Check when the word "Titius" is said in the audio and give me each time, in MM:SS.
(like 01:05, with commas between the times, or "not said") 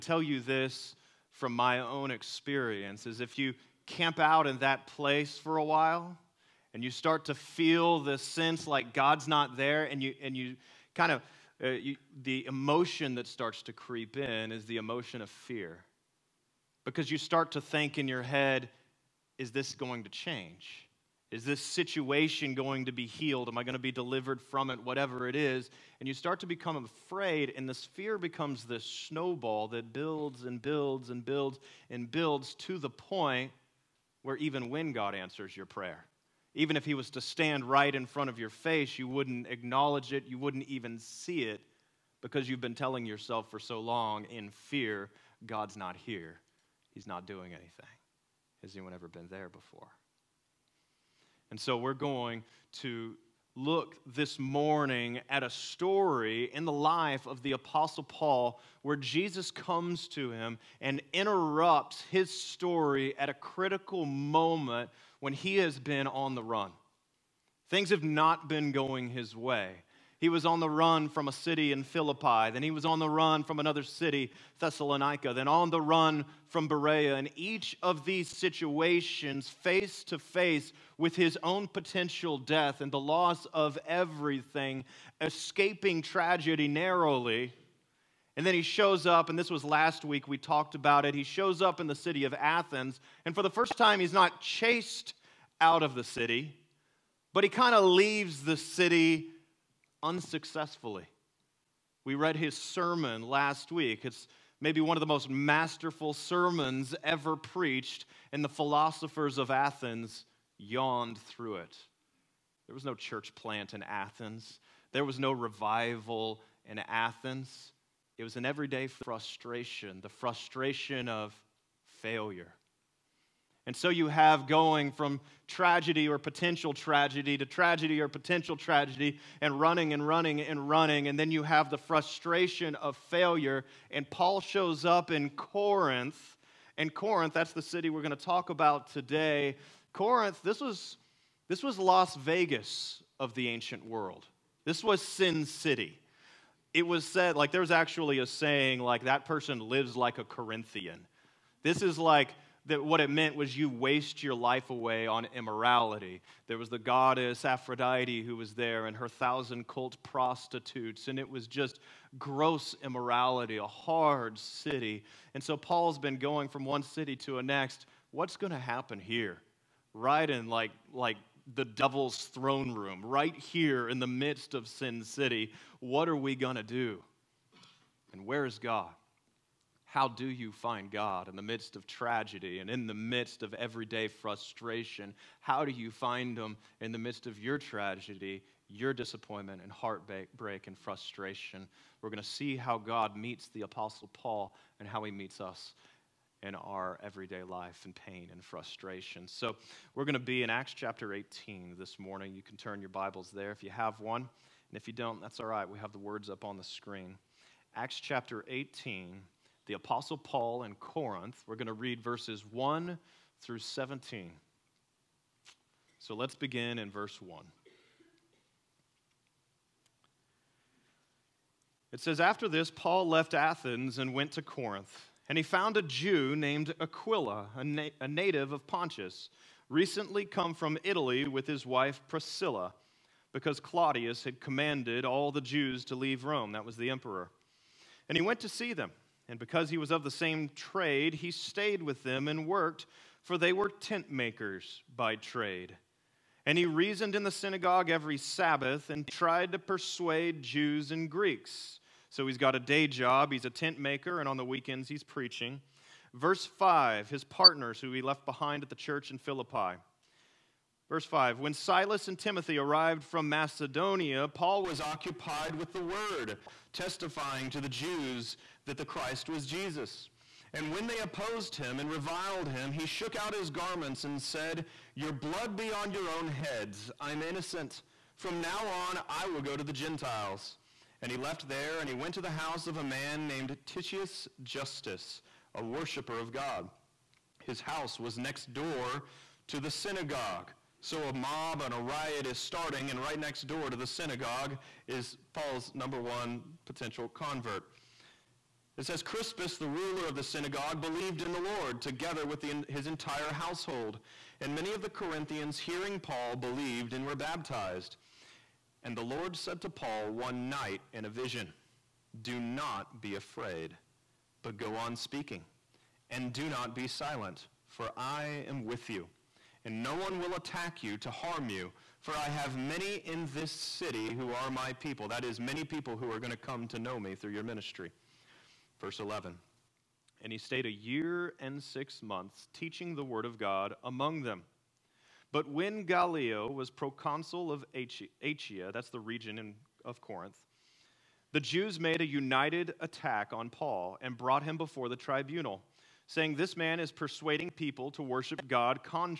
04:43.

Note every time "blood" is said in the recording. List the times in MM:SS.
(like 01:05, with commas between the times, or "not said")
04:35.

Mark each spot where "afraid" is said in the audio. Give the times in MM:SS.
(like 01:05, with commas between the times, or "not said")
00:26, 05:13.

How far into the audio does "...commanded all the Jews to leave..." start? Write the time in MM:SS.
03:54.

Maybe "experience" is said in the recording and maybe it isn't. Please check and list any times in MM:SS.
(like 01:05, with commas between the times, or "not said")
00:02.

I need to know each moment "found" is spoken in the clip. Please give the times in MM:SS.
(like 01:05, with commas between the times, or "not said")
03:45.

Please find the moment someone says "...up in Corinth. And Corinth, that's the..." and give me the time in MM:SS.
02:14.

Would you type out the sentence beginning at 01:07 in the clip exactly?
Things have not been going his way.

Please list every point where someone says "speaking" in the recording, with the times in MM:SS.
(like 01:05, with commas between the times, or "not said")
05:14.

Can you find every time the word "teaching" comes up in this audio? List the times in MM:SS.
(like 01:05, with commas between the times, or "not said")
05:32.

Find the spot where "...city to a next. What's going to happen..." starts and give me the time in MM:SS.
02:46.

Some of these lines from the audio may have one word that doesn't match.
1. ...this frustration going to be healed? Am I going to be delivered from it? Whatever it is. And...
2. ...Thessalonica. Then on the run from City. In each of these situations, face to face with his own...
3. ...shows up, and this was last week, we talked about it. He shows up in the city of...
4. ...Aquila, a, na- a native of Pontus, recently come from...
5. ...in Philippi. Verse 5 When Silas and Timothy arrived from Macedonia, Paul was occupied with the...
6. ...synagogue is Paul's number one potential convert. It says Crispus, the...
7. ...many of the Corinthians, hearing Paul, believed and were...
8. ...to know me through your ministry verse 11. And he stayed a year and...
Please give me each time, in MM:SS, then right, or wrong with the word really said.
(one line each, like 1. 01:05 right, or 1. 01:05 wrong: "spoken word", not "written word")
1. 00:21 wrong: "situation", not "frustration"
2. 01:14 wrong: "Berea", not "City"
3. 01:28 right
4. 03:46 right
5. 04:19 right
6. 04:53 right
7. 05:04 right
8. 05:26 right.